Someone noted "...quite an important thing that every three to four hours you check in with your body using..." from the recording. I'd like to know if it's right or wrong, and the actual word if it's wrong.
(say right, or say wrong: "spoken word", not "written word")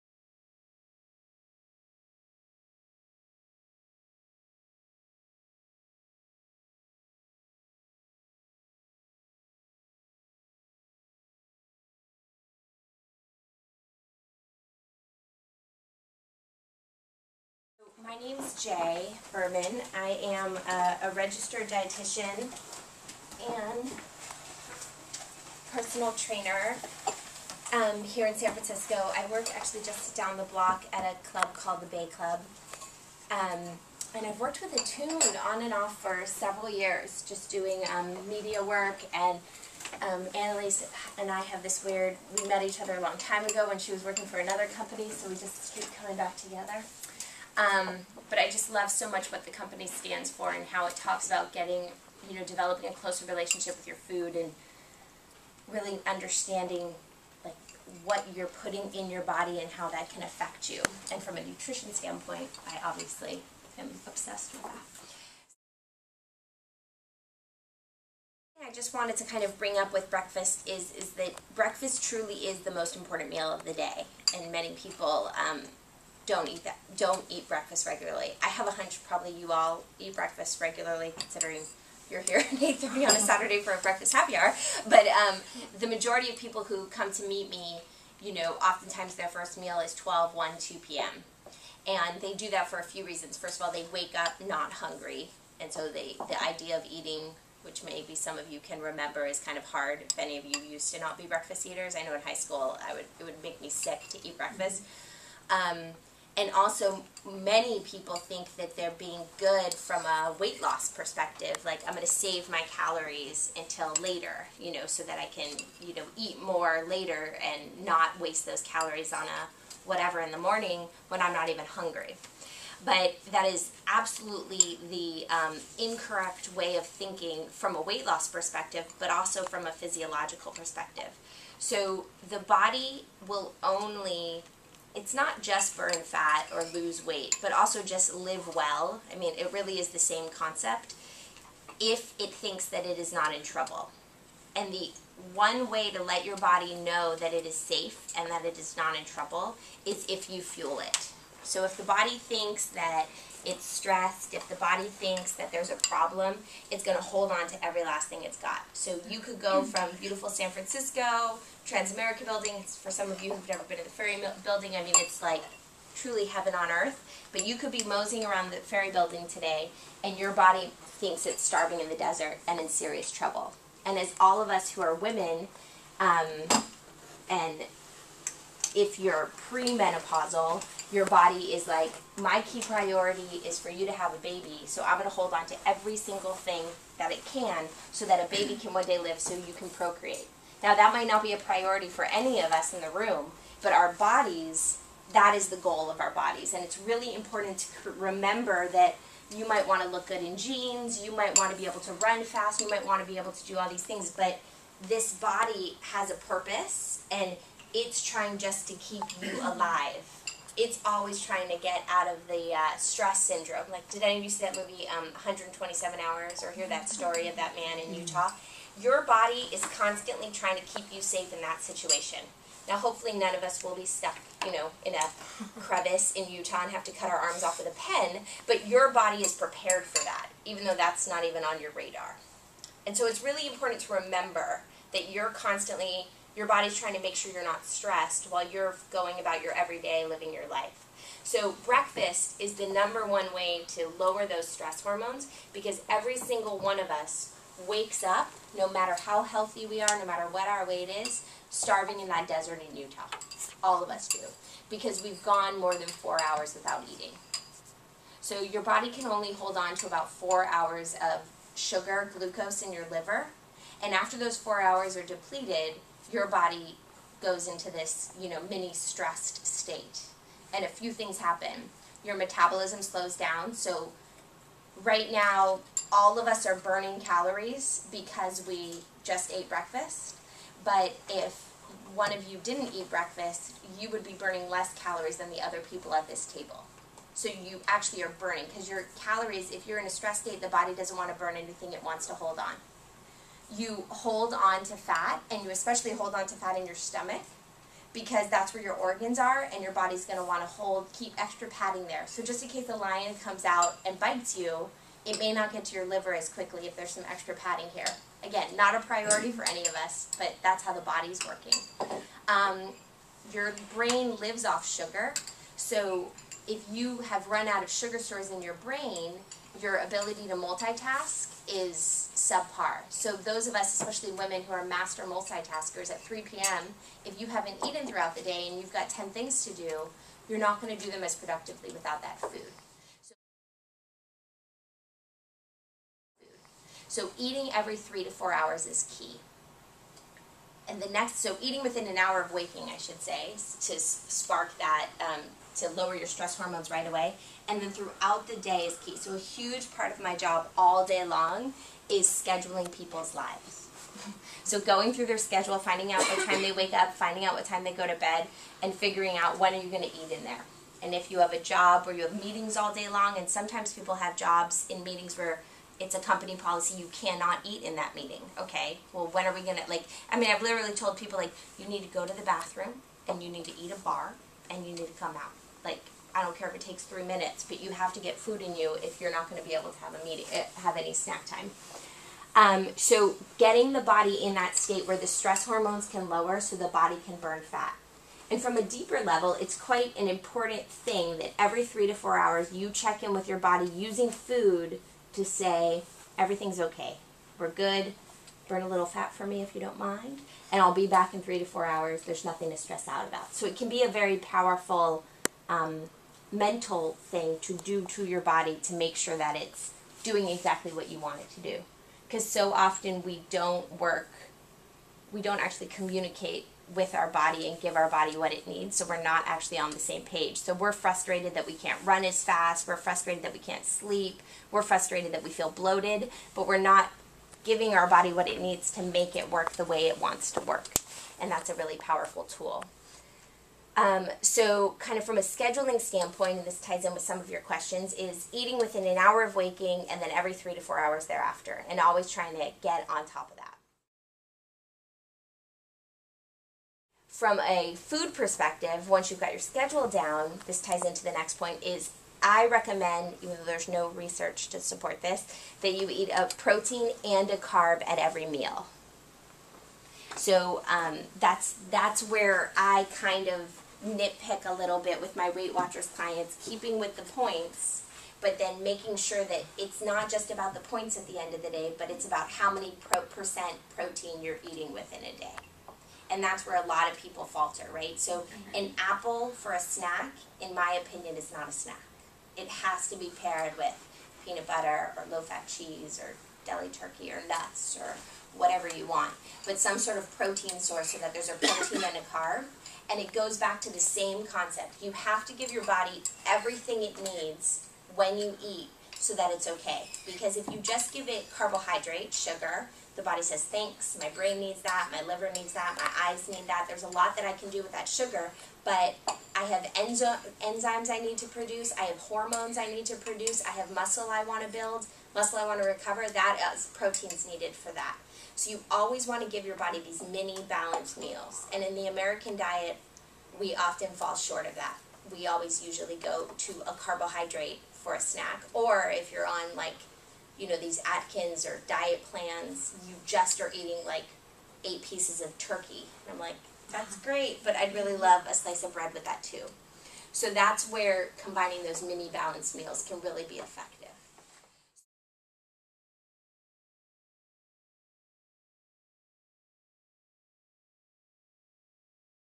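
right.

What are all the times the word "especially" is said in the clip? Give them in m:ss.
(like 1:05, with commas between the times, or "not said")
4:55, 5:23.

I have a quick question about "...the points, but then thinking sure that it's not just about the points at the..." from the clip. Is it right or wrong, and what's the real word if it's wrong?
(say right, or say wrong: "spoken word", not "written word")
wrong: "making", not "thinking".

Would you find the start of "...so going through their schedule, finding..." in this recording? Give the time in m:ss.
5:54.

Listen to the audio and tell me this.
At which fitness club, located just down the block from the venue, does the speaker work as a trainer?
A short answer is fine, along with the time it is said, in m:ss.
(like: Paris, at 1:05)
Bay Club, at 0:31.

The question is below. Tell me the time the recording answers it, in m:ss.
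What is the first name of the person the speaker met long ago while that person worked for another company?
0:40.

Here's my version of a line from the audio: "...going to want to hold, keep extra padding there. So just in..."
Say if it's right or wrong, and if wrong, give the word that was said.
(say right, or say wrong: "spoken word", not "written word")
right.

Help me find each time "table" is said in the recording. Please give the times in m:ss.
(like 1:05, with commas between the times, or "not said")
4:46.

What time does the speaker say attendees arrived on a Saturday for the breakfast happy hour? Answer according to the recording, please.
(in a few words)
8:30.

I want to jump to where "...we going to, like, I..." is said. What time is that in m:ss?
6:09.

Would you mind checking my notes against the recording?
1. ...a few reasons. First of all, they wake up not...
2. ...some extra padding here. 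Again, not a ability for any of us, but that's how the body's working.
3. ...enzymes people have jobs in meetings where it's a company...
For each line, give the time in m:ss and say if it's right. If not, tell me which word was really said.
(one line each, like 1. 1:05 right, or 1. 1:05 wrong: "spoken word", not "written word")
1. 1:32 right
2. 5:06 wrong: "priority", not "ability"
3. 6:03 wrong: "sometimes", not "enzymes".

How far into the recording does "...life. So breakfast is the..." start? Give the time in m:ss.
4:00.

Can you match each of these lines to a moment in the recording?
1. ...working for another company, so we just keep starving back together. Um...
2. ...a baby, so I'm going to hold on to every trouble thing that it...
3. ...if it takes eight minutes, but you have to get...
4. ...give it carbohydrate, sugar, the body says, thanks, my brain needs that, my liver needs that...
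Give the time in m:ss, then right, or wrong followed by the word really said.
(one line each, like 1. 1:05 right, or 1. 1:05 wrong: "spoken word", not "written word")
1. 0:44 wrong: "coming", not "starving"
2. 3:04 wrong: "single", not "trouble"
3. 6:16 wrong: "three", not "eight"
4. 8:20 right.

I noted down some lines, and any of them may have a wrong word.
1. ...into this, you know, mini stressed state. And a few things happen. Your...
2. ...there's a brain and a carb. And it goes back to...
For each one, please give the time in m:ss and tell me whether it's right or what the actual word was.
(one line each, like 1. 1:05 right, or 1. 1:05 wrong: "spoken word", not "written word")
1. 4:27 right
2. 8:11 wrong: "protein", not "brain".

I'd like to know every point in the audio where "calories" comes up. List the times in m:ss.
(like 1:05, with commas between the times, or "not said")
1:52, 1:58, 4:36, 4:44, 4:48.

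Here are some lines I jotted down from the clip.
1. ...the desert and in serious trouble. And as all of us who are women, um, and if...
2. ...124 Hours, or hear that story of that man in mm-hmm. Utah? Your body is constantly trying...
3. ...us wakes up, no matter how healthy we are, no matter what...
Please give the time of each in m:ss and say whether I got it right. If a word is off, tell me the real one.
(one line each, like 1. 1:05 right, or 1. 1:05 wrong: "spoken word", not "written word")
1. 2:51 right
2. 3:35 wrong: "127", not "124"
3. 4:06 right.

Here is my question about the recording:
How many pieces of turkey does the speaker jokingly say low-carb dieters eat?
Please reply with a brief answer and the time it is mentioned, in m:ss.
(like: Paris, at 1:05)
8, at 8:54.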